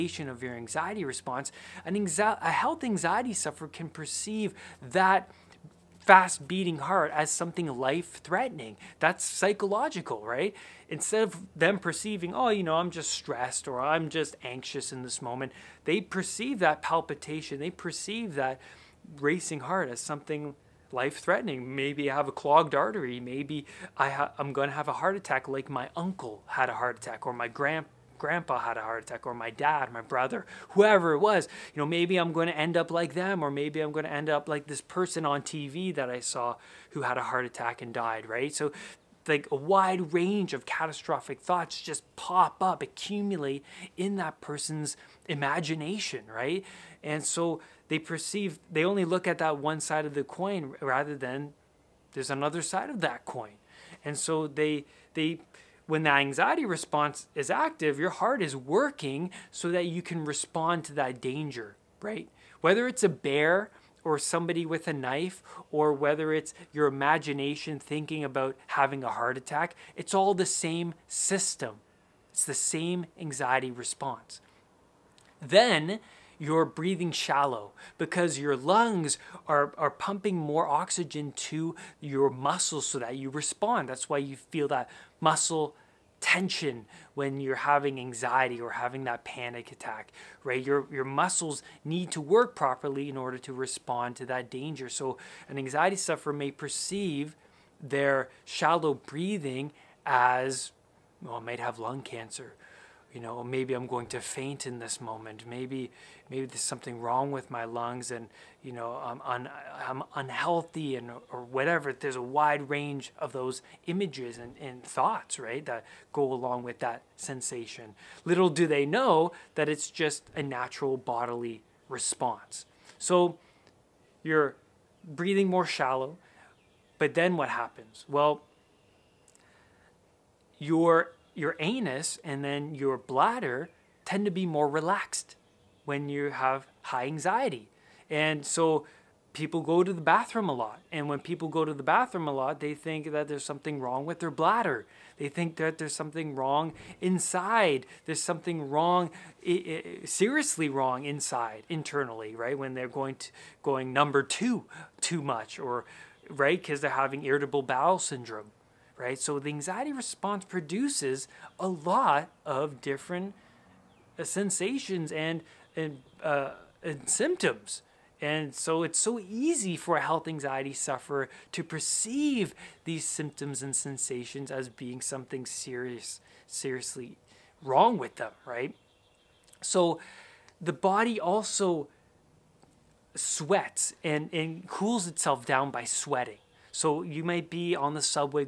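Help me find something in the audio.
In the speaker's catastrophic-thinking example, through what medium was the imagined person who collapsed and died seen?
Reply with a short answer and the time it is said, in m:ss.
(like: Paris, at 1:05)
TV, at 0:35.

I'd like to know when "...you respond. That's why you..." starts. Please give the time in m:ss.
1:23.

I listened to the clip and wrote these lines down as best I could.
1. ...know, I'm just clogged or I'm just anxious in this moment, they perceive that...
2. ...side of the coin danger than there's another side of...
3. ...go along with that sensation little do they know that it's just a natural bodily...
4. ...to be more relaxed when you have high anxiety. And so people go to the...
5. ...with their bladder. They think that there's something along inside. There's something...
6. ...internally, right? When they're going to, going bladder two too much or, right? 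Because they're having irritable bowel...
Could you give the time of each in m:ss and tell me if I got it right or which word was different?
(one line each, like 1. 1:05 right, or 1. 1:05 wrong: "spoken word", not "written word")
1. 0:12 wrong: "stressed", not "clogged"
2. 0:49 wrong: "rather", not "danger"
3. 1:56 right
4. 2:14 right
5. 2:24 wrong: "wrong", not "along"
6. 2:31 wrong: "number", not "bladder".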